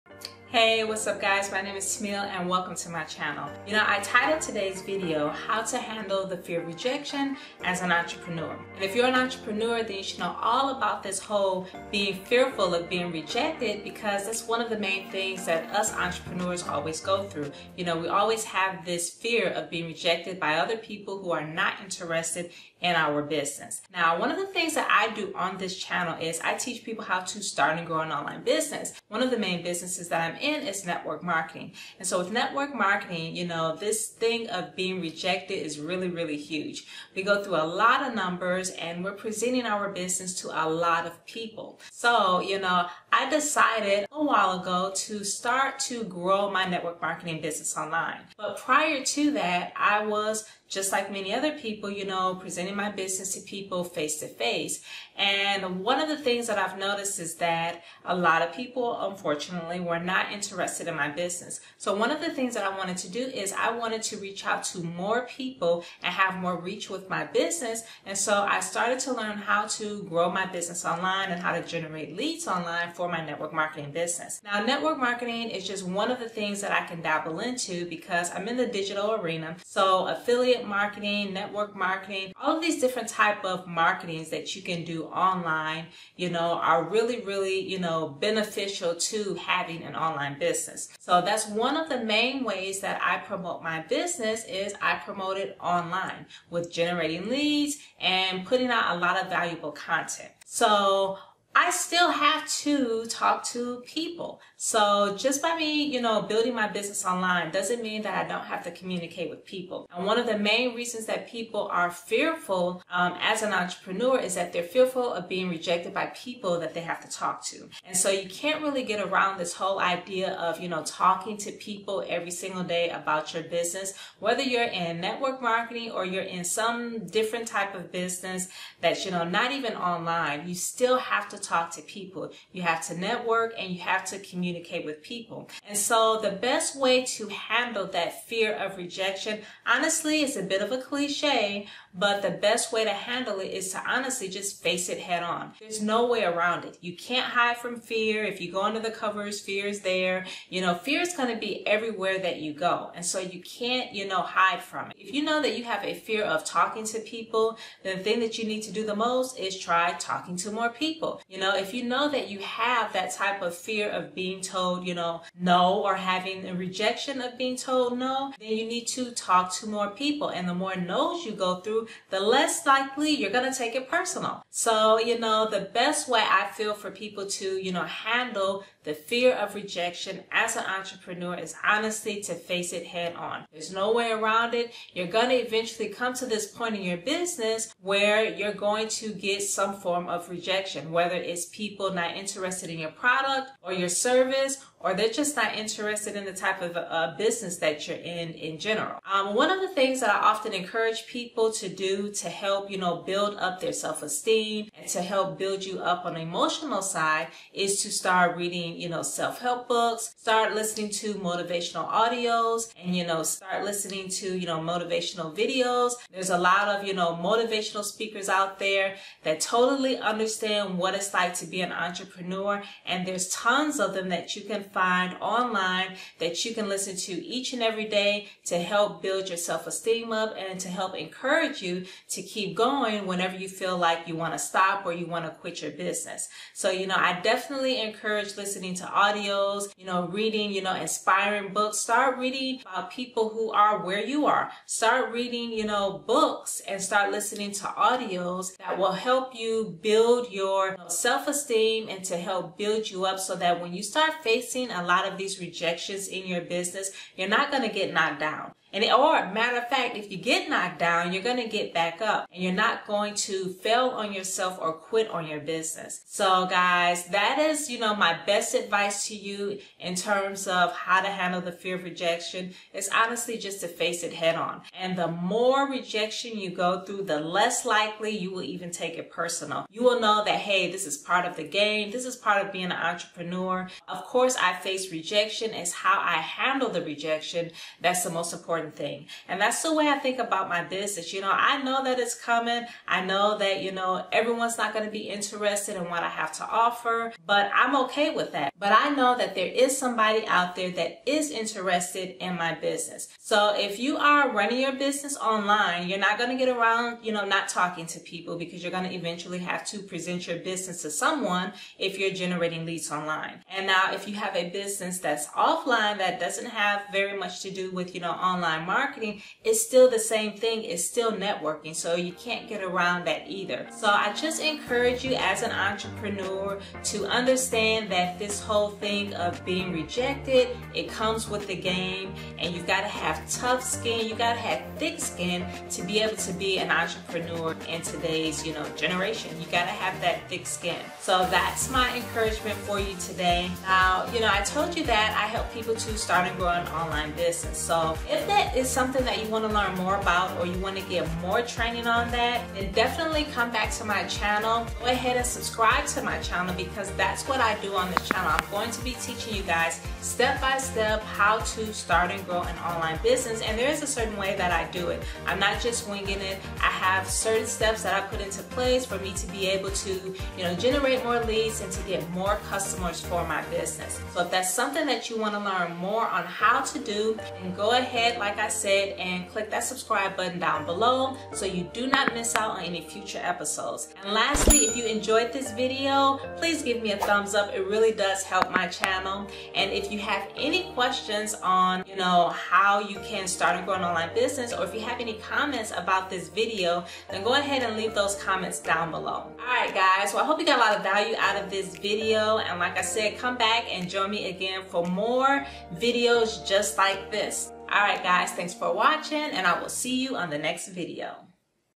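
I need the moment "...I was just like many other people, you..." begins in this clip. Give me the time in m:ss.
0:49.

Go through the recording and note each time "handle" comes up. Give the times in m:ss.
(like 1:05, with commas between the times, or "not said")
0:05, 2:17, 2:22, 2:57, 4:31, 4:46.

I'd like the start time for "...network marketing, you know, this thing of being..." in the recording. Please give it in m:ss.
0:32.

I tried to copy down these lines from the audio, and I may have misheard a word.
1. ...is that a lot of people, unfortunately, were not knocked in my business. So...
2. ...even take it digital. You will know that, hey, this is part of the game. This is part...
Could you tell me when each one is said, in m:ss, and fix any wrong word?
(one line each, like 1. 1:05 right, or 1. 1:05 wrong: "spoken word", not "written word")
1. 0:57 wrong: "interested", not "knocked"
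2. 4:38 wrong: "personal", not "digital".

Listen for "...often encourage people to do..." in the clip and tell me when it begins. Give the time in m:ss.
3:20.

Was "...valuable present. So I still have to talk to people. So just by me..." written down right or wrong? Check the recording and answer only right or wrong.
wrong.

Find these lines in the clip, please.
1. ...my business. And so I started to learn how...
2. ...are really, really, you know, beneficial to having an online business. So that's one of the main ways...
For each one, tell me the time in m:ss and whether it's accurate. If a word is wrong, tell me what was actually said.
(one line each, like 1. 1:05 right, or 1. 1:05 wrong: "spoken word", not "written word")
1. 1:07 right
2. 1:26 right.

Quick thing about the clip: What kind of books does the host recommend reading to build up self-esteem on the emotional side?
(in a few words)
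self-help books.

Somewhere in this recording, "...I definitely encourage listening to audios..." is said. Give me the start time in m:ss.
3:56.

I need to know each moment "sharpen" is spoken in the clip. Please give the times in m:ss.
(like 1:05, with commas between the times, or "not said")
not said.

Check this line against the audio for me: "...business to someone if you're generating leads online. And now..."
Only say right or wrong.
right.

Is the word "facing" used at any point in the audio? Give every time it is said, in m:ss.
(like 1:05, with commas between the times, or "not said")
4:14.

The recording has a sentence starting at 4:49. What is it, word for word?
And that's the way I think about my business.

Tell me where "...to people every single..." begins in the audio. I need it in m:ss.
2:01.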